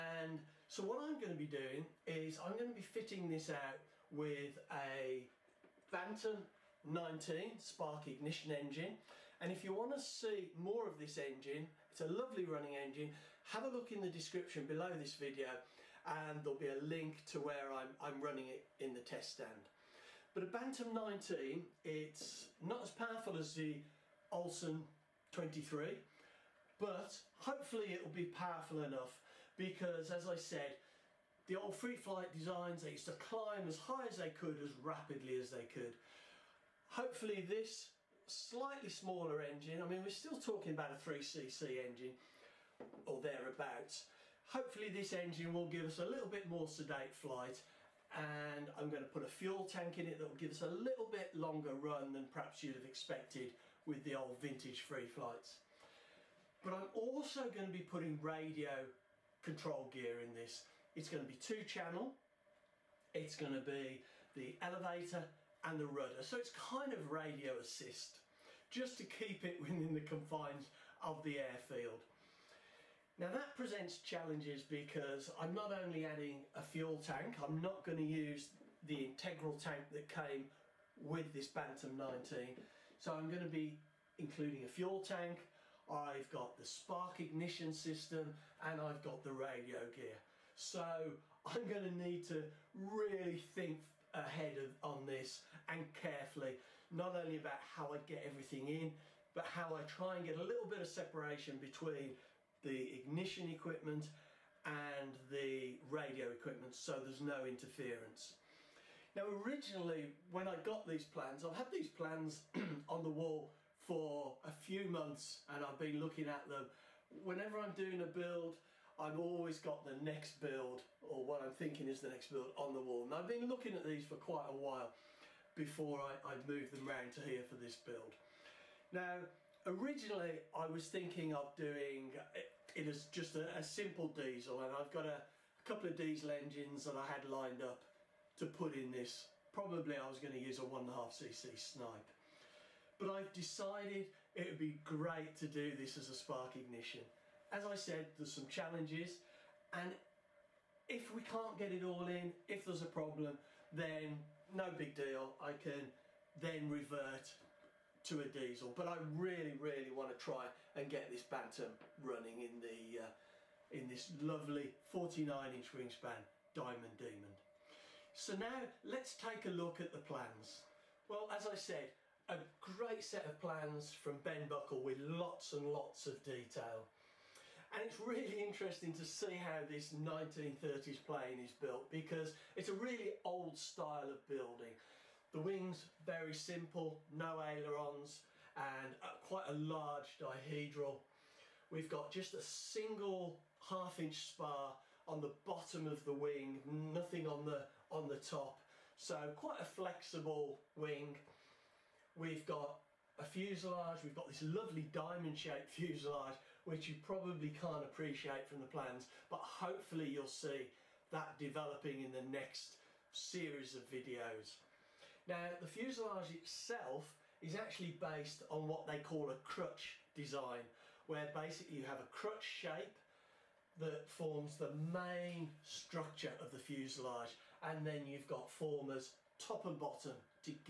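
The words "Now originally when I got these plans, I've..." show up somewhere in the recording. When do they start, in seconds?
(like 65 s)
109 s.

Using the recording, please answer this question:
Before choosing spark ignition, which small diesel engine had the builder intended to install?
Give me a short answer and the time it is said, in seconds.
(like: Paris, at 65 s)
1.5cc Snipe, at 140 s.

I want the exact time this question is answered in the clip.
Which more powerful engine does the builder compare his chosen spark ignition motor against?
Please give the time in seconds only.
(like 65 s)
24 s.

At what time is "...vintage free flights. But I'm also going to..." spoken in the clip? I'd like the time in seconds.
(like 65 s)
54 s.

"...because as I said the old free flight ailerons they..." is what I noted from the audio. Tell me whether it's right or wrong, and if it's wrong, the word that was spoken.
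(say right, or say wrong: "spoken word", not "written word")
wrong: "designs", not "ailerons".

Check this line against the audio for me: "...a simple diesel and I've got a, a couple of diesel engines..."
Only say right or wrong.
right.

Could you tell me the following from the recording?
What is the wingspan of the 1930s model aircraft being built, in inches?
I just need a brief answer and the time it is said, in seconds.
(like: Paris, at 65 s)
49 inches, at 164 s.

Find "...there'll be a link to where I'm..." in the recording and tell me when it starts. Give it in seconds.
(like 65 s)
16 s.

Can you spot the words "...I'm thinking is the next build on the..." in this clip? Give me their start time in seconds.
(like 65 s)
121 s.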